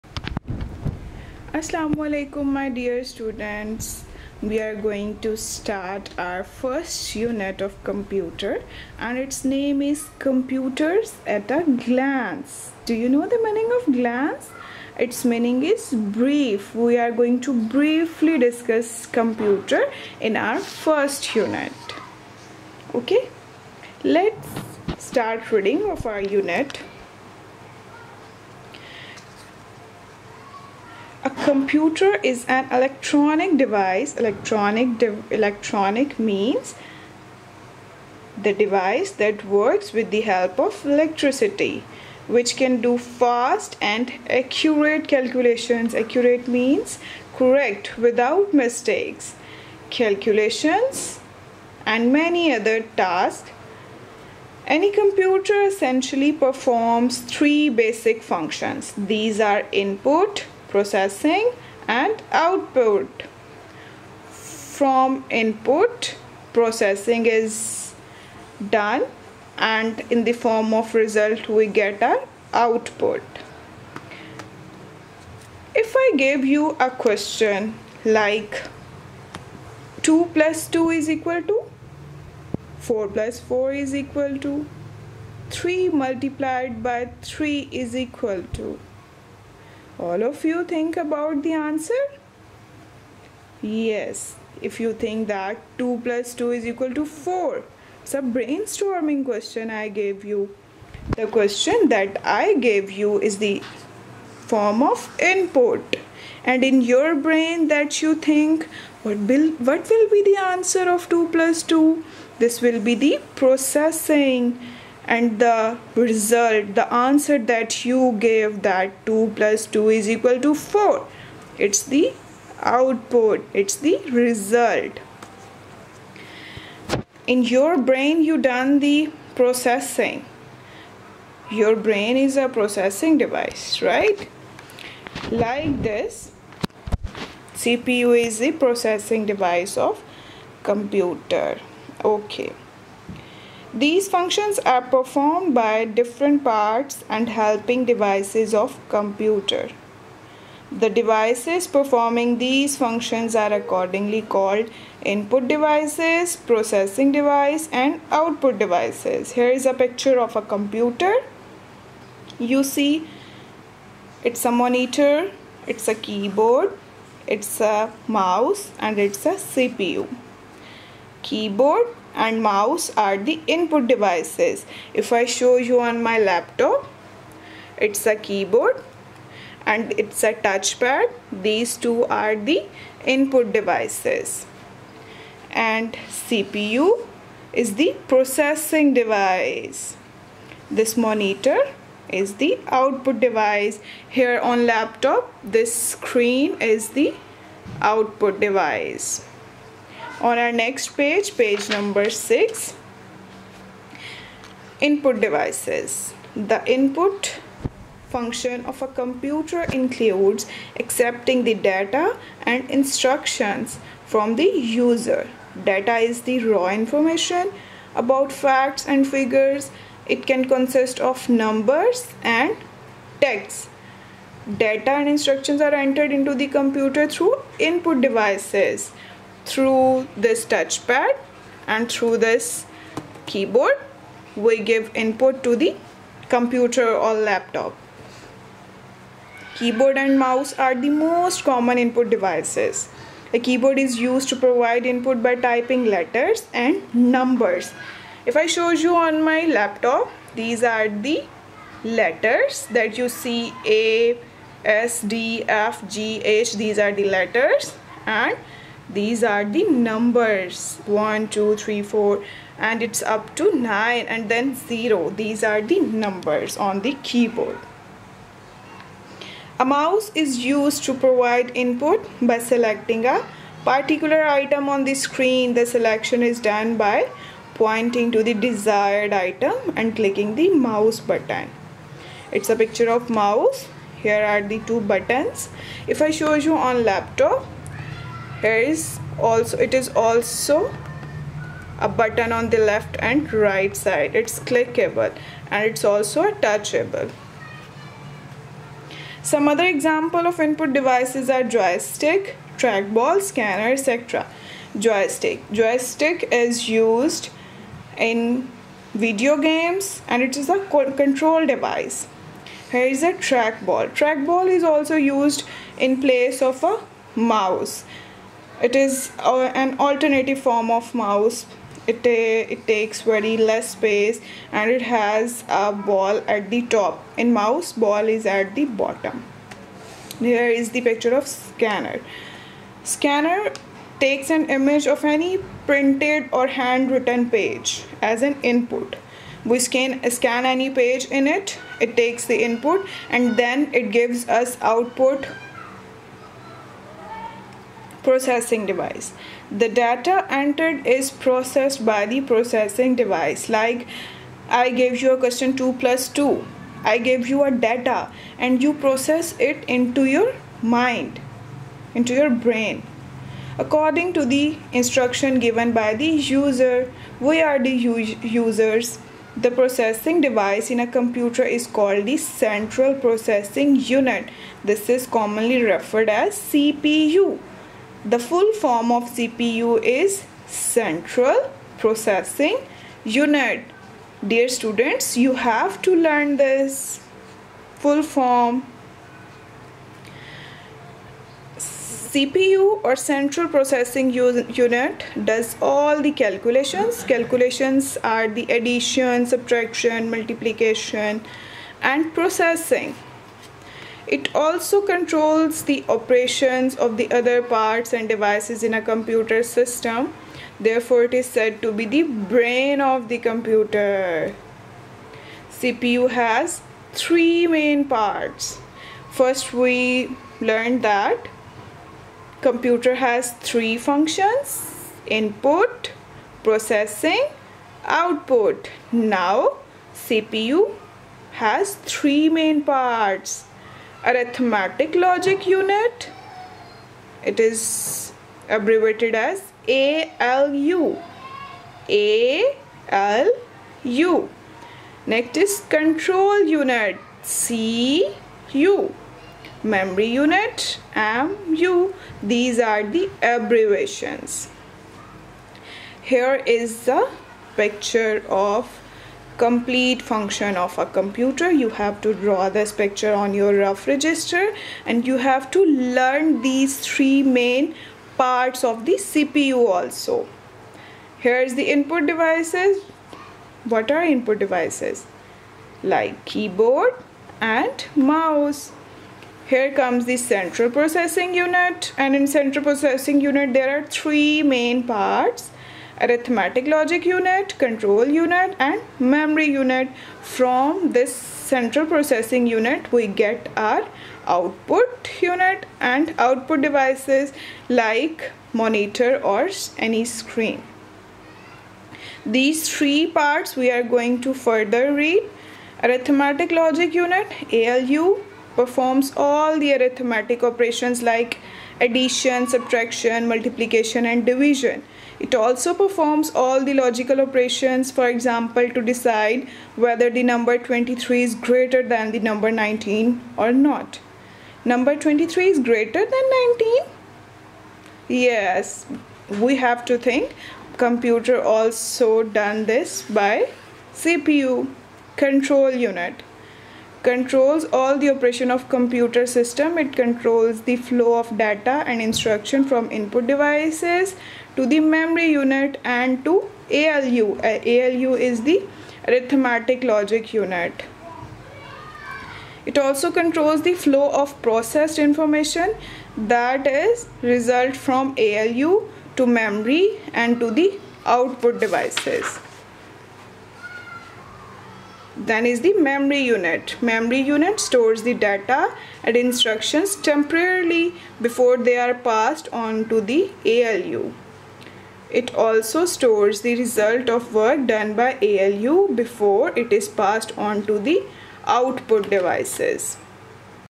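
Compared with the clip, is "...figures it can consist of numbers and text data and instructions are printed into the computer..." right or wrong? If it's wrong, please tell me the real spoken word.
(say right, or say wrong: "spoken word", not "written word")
wrong: "entered", not "printed".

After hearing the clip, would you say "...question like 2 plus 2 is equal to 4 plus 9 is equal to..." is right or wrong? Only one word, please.
wrong.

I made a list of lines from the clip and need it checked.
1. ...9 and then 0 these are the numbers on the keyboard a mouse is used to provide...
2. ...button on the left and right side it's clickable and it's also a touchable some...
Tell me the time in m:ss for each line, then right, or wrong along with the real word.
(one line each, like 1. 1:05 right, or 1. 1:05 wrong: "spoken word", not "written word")
1. 4:23 right
2. 4:51 right.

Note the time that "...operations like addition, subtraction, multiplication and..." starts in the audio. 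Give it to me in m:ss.
8:30.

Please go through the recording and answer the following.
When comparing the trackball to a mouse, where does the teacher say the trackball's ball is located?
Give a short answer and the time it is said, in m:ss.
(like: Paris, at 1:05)
at the top, at 5:26.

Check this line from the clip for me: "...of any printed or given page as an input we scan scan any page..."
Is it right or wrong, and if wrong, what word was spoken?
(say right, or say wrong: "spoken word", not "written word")
wrong: "handwritten", not "given".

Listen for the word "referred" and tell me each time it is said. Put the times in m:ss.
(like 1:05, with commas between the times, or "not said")
6:15.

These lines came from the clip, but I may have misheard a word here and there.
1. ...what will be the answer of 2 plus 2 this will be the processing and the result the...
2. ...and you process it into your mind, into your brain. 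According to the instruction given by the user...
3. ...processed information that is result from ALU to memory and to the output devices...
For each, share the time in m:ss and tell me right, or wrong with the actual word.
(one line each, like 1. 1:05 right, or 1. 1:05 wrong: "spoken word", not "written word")
1. 1:49 right
2. 5:58 right
3. 9:14 right.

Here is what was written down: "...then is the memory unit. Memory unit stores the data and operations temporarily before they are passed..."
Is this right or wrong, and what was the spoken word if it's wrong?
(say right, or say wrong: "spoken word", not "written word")
wrong: "instructions", not "operations".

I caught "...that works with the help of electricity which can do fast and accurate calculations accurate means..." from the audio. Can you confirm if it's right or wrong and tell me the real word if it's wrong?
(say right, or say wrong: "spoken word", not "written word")
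right.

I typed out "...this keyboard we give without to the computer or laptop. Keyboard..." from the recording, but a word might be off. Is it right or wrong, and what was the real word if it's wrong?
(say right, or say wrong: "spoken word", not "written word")
wrong: "input", not "without".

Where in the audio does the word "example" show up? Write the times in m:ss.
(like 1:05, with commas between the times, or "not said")
4:59, 8:38.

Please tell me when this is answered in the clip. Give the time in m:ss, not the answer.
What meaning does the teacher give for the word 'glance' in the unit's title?
0:15.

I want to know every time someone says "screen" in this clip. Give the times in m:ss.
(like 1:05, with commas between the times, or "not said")
3:15, 4:35, 8:20.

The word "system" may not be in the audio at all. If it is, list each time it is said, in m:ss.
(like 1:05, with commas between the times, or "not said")
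6:49, 8:59.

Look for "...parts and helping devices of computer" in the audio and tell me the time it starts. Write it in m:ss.
2:26.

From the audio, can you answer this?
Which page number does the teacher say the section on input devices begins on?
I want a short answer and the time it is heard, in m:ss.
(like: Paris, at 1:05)
6, at 3:21.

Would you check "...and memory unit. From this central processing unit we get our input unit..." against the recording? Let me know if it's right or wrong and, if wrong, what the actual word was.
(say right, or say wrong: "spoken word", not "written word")
wrong: "output", not "input".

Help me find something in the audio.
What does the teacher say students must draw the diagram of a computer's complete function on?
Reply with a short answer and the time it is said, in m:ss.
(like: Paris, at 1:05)
rough register, at 7:43.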